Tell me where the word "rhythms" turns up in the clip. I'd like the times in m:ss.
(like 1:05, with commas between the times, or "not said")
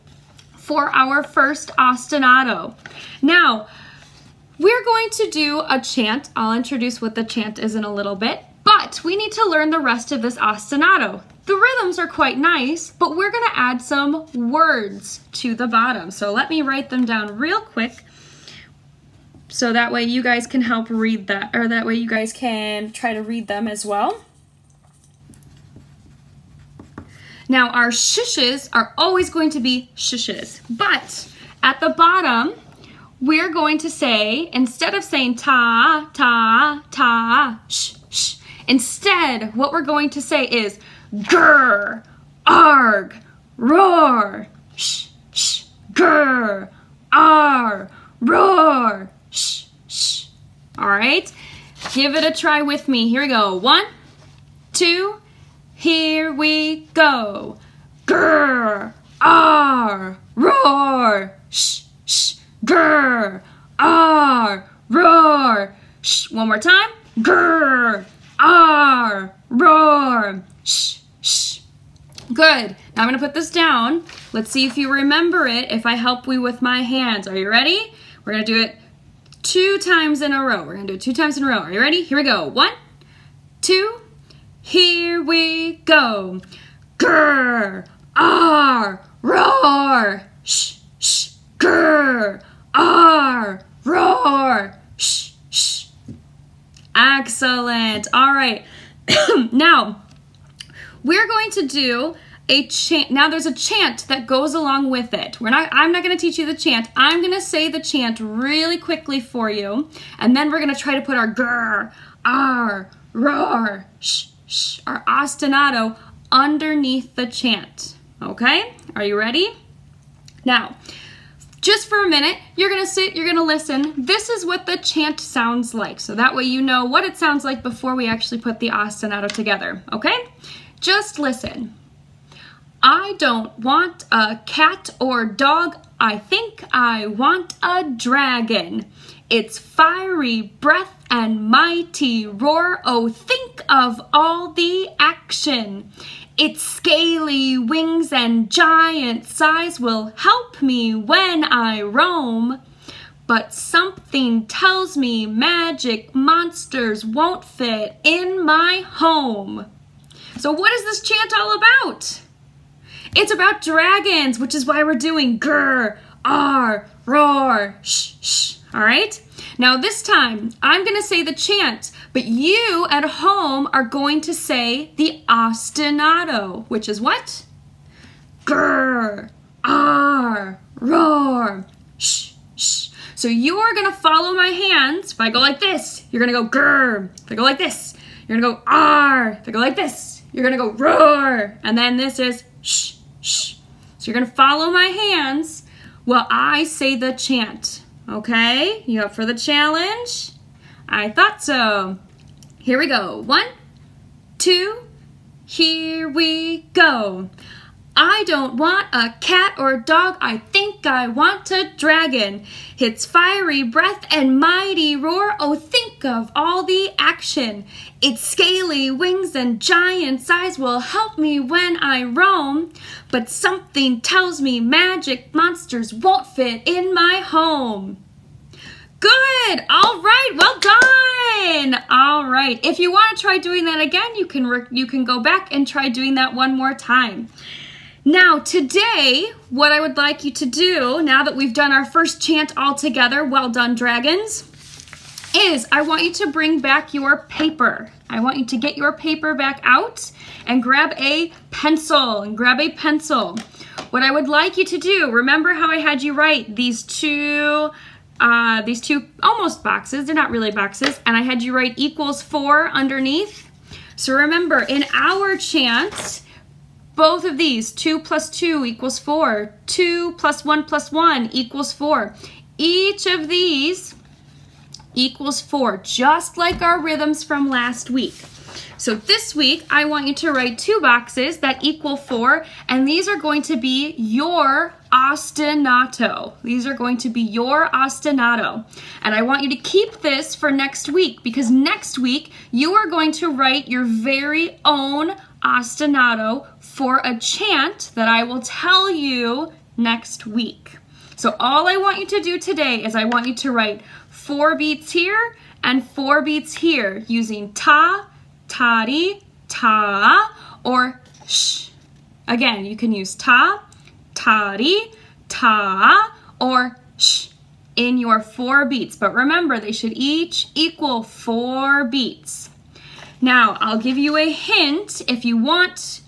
0:11, 4:36.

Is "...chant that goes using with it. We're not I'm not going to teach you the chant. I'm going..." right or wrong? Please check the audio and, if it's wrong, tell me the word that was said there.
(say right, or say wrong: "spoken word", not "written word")
wrong: "along", not "using".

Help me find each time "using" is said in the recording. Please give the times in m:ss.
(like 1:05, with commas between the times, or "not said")
5:07.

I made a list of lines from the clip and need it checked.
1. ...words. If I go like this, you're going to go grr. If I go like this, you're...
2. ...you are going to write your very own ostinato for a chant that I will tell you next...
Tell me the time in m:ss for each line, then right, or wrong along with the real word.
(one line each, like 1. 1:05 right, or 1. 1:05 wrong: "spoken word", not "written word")
1. 3:04 wrong: "hands", not "words"
2. 4:52 right.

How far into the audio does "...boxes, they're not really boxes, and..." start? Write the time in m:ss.
4:19.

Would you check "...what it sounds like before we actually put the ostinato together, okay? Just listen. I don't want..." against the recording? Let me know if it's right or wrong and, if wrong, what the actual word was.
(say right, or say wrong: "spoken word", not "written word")
right.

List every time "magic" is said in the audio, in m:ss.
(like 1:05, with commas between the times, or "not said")
2:35, 3:44.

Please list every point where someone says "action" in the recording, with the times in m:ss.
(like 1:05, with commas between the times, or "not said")
2:24, 3:36.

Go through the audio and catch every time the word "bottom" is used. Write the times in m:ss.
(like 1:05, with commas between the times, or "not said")
0:15, 0:31.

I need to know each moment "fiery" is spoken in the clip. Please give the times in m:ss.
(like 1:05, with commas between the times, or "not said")
2:19, 3:33.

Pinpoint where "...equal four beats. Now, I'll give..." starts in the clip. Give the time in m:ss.
5:20.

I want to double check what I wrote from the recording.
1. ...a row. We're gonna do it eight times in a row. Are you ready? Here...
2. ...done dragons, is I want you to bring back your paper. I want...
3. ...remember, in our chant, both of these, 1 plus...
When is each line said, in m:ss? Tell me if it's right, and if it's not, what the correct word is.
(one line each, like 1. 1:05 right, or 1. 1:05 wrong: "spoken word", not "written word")
1. 1:20 wrong: "two", not "eight"
2. 4:03 right
3. 4:24 wrong: "2", not "1".